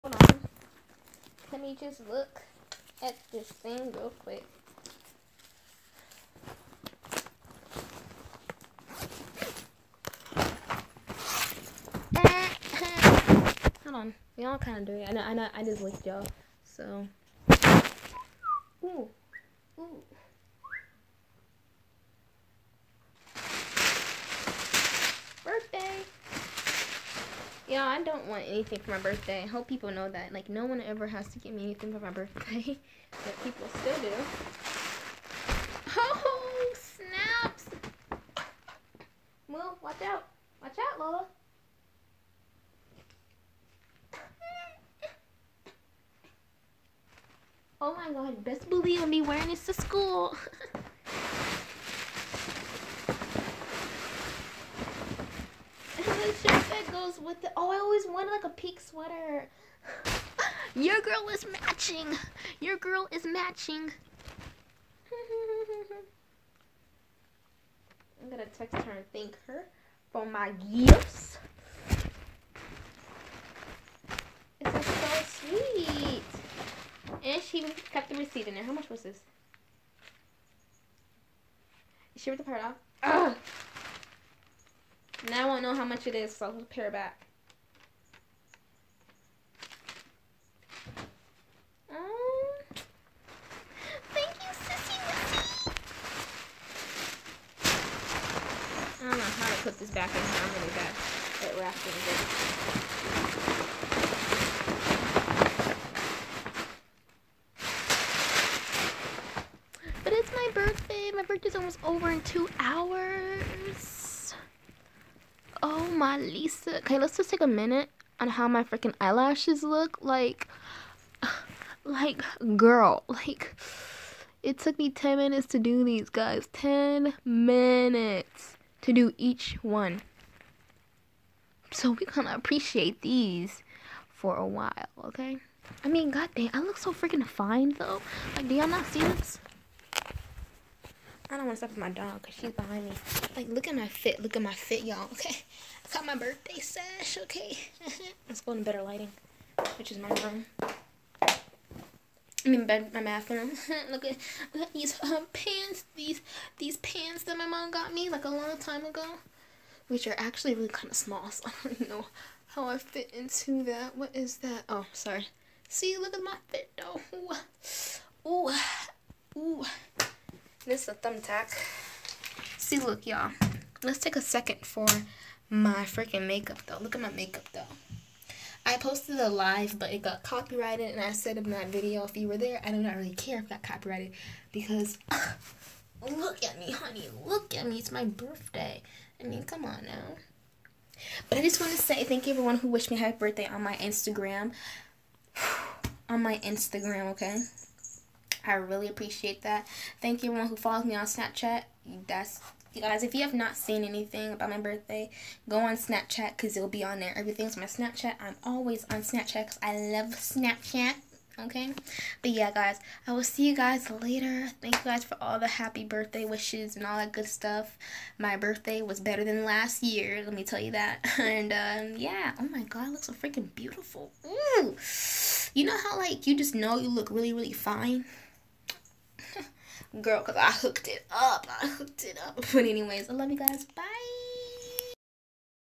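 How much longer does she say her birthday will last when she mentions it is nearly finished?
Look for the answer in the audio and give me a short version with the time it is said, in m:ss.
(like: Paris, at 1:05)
2 hours, at 1:52.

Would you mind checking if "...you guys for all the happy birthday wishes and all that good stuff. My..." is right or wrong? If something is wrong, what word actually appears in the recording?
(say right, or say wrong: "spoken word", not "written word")
right.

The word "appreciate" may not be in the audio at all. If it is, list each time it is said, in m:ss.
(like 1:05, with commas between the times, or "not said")
2:12, 3:18.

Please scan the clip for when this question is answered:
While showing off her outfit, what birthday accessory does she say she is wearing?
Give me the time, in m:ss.
2:26.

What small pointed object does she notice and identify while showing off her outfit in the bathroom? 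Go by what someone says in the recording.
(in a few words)
Thumbtack.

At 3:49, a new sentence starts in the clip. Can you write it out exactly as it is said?
girl because I hooked it up.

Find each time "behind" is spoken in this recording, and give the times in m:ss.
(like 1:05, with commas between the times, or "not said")
2:22.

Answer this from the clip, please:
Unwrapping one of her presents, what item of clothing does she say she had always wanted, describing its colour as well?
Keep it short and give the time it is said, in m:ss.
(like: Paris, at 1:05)
Pink sweater, at 0:58.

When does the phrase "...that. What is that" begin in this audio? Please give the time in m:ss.
2:43.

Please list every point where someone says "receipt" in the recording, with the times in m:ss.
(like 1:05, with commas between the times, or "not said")
1:18.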